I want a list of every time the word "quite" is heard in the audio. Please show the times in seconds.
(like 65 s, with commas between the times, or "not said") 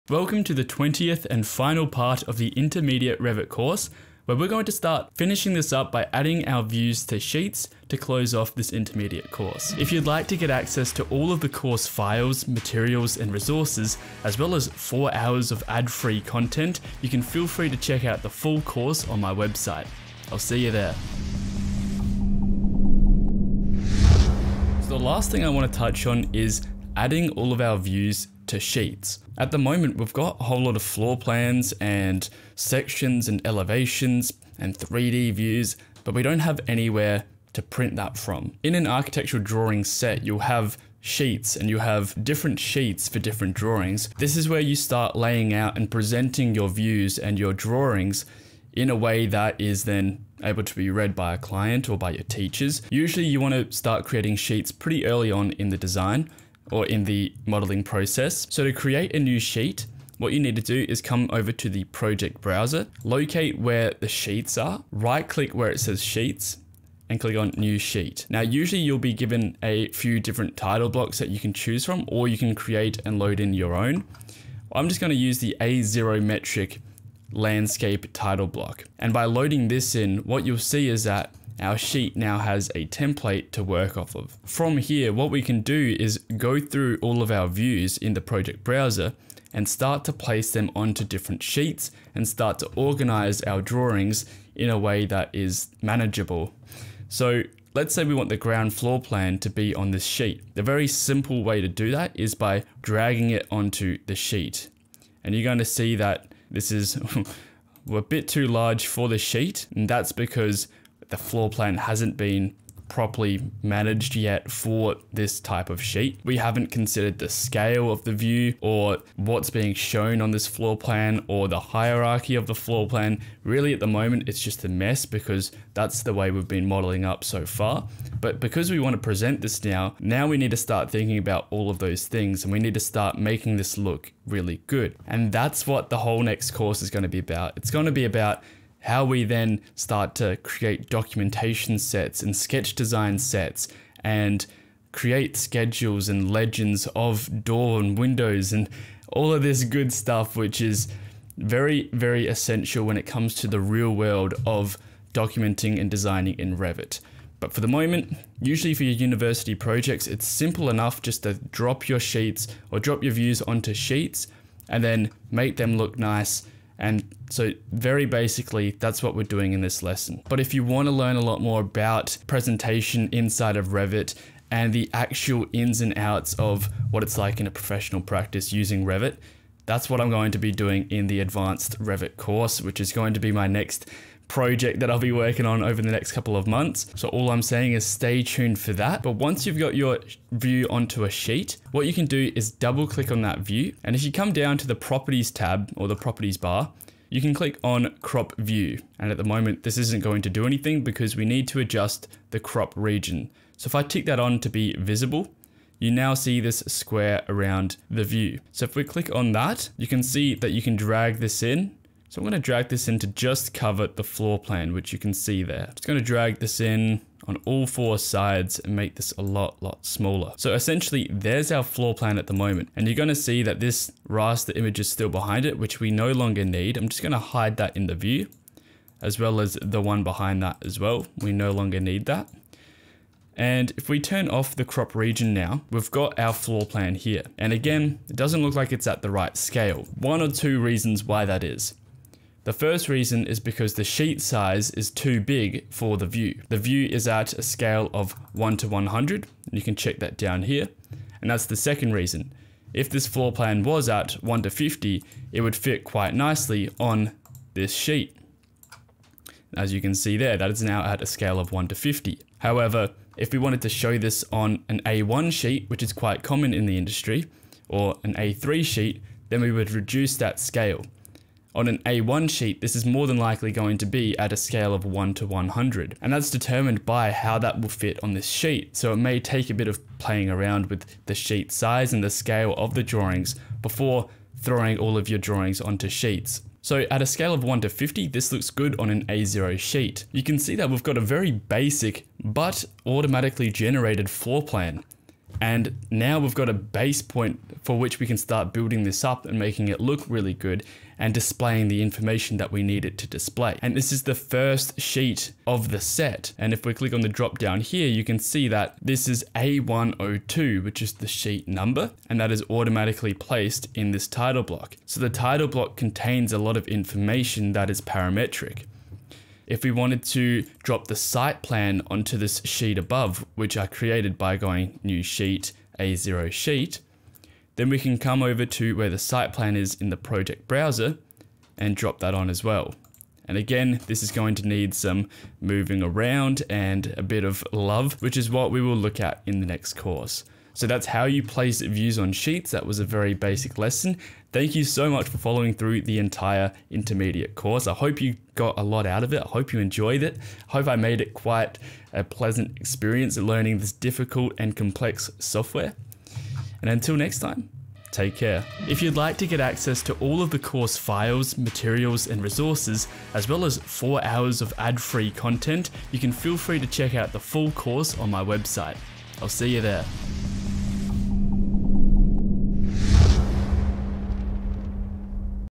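255 s, 265 s, 351 s.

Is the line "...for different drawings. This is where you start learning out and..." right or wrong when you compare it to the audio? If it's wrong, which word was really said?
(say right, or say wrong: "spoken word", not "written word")
wrong: "laying", not "learning".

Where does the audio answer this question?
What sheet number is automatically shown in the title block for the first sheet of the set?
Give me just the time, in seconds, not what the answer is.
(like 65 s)
309 s.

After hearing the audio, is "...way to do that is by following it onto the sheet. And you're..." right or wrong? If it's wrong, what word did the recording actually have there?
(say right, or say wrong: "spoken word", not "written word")
wrong: "dragging", not "following".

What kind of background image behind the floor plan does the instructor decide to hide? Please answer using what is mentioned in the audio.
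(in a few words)
Raster image.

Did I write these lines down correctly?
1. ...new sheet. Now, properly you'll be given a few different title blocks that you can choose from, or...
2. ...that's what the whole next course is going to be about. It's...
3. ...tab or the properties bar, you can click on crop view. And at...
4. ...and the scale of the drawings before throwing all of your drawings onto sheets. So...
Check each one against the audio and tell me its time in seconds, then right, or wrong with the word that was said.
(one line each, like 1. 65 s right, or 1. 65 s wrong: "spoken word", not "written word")
1. 67 s wrong: "usually", not "properly"
2. 135 s right
3. 195 s right
4. 281 s right.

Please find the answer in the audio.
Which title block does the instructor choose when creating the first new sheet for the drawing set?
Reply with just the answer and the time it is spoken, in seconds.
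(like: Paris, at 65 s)
A0 metric landscape, at 75 s.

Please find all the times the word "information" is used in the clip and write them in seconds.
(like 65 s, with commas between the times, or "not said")
301 s, 316 s.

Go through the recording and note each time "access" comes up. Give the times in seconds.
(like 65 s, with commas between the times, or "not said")
10 s, 359 s.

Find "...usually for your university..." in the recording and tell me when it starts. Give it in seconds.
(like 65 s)
158 s.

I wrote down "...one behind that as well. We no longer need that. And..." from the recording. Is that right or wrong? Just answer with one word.
right.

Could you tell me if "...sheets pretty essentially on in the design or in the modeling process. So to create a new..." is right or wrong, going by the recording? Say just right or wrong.
wrong.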